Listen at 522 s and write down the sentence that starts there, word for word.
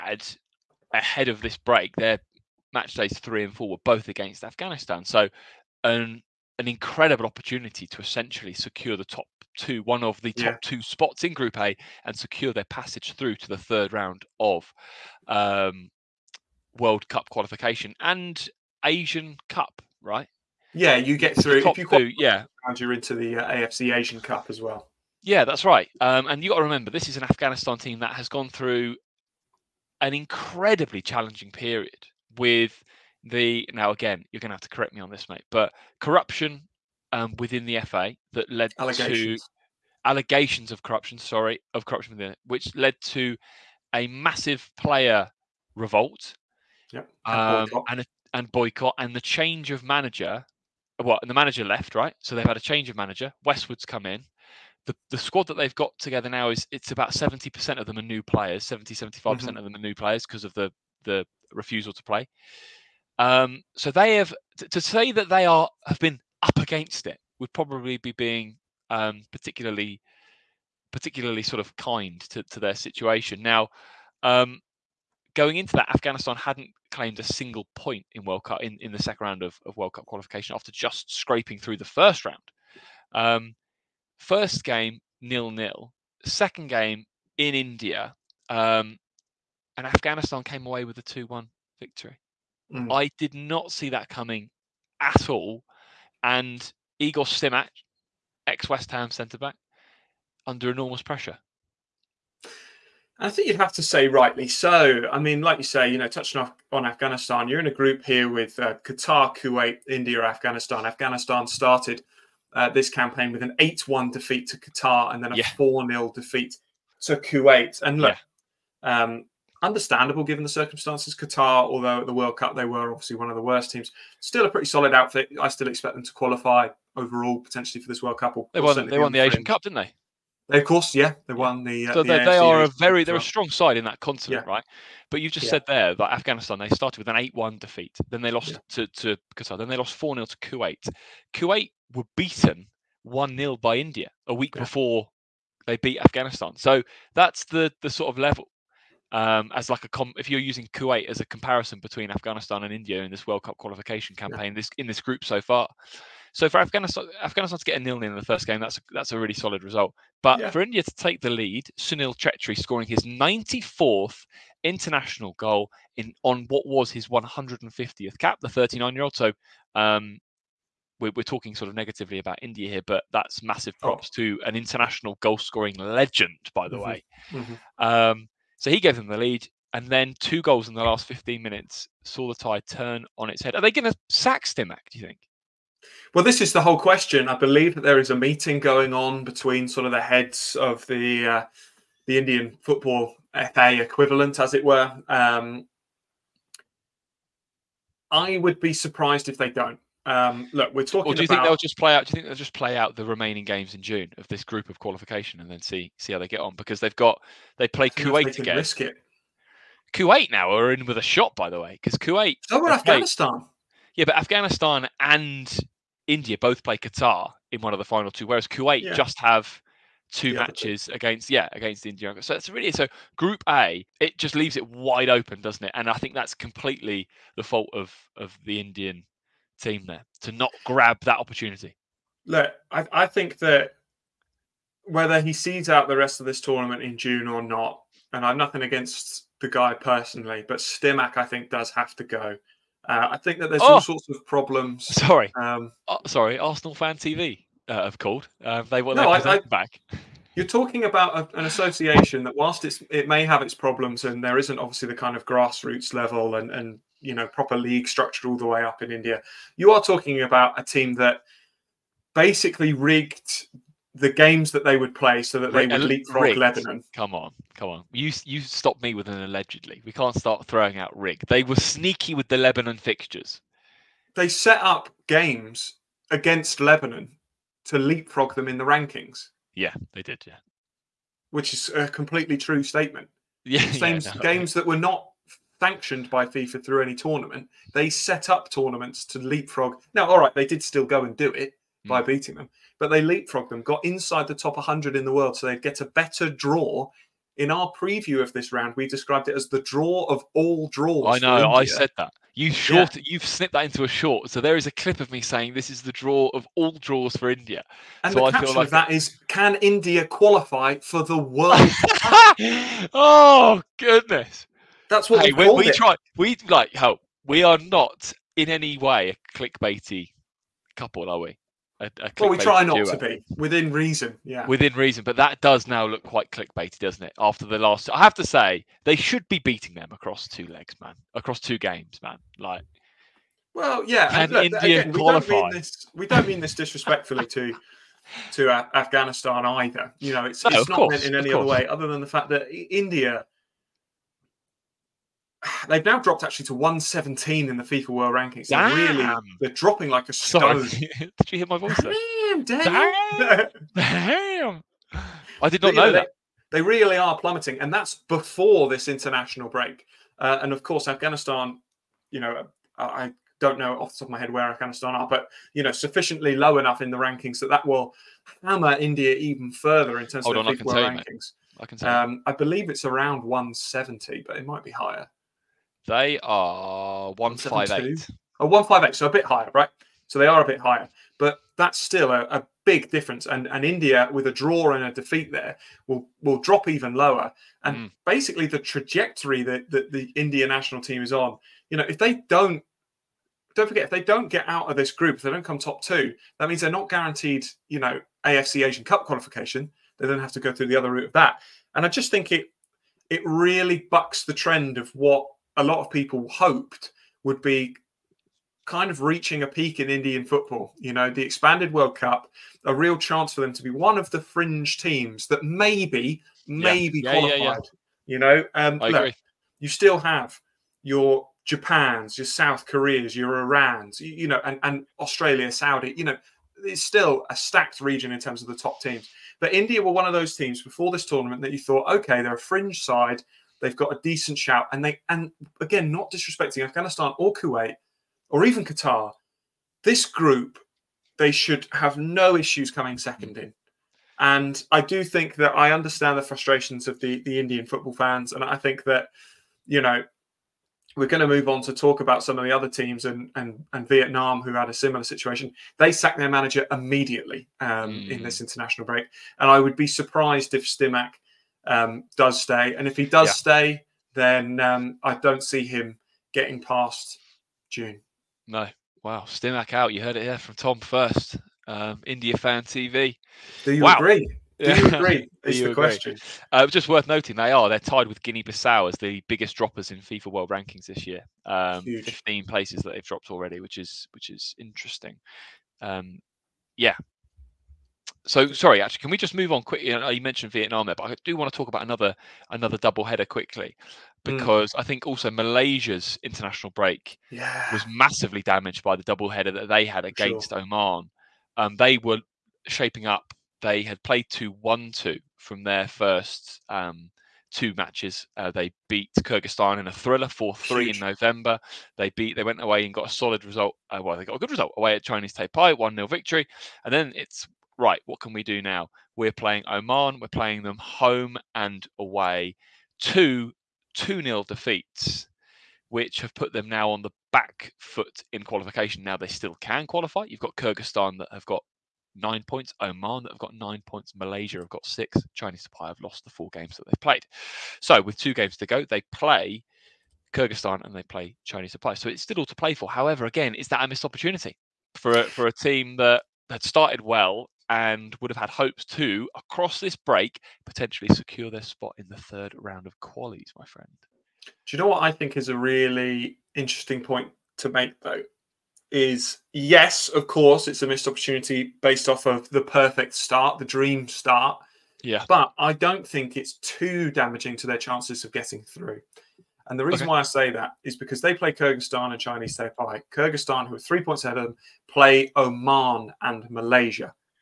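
Two 2 0 defeats, which have put them now on the back foot in qualification.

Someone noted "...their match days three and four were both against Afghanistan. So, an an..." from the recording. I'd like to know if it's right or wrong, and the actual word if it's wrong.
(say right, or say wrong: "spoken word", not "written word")
right.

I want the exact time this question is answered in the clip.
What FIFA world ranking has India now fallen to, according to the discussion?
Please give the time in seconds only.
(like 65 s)
346 s.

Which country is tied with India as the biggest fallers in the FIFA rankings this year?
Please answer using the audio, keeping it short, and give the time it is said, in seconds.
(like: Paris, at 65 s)
Guinea-Bissau, at 478 s.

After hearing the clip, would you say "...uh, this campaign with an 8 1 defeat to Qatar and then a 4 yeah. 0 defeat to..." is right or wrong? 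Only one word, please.
right.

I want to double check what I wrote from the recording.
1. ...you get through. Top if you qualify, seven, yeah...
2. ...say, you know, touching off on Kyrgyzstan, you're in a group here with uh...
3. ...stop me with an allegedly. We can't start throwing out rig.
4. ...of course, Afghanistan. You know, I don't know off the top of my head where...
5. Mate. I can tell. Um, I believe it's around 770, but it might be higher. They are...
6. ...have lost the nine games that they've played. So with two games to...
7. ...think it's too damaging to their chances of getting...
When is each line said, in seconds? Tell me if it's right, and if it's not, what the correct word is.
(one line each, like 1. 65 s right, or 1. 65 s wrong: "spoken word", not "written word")
1. 20 s wrong: "two", not "seven"
2. 105 s wrong: "Afghanistan", not "Kyrgyzstan"
3. 268 s right
4. 360 s right
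5. 371 s wrong: "170", not "770"
6. 535 s wrong: "four", not "nine"
7. 566 s right.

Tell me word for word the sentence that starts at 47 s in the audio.
Um, and a, and boycott and the change of manager.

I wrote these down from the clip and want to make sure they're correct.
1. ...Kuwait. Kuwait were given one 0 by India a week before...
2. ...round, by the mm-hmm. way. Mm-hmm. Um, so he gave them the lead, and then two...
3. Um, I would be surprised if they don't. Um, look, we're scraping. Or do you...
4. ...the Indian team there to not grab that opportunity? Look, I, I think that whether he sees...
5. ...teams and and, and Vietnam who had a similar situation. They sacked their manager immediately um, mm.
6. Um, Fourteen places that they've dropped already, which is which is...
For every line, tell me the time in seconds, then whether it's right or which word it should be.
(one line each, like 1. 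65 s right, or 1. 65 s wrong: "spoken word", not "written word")
1. 140 s wrong: "beaten", not "given"
2. 175 s wrong: "legend", not "round"
3. 195 s wrong: "talking", not "scraping"
4. 228 s right
5. 452 s right
6. 481 s wrong: "Fifteen", not "Fourteen".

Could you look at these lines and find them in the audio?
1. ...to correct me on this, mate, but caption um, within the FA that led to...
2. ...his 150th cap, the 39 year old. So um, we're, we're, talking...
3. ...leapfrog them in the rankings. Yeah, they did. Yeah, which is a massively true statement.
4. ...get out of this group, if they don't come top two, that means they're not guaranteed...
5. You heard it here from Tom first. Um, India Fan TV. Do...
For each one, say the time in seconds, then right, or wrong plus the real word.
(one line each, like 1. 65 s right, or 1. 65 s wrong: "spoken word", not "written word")
1. 34 s wrong: "corruption", not "caption"
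2. 166 s right
3. 277 s wrong: "completely", not "massively"
4. 394 s right
5. 469 s right.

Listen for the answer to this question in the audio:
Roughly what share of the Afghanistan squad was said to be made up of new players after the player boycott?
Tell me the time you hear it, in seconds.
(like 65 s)
58 s.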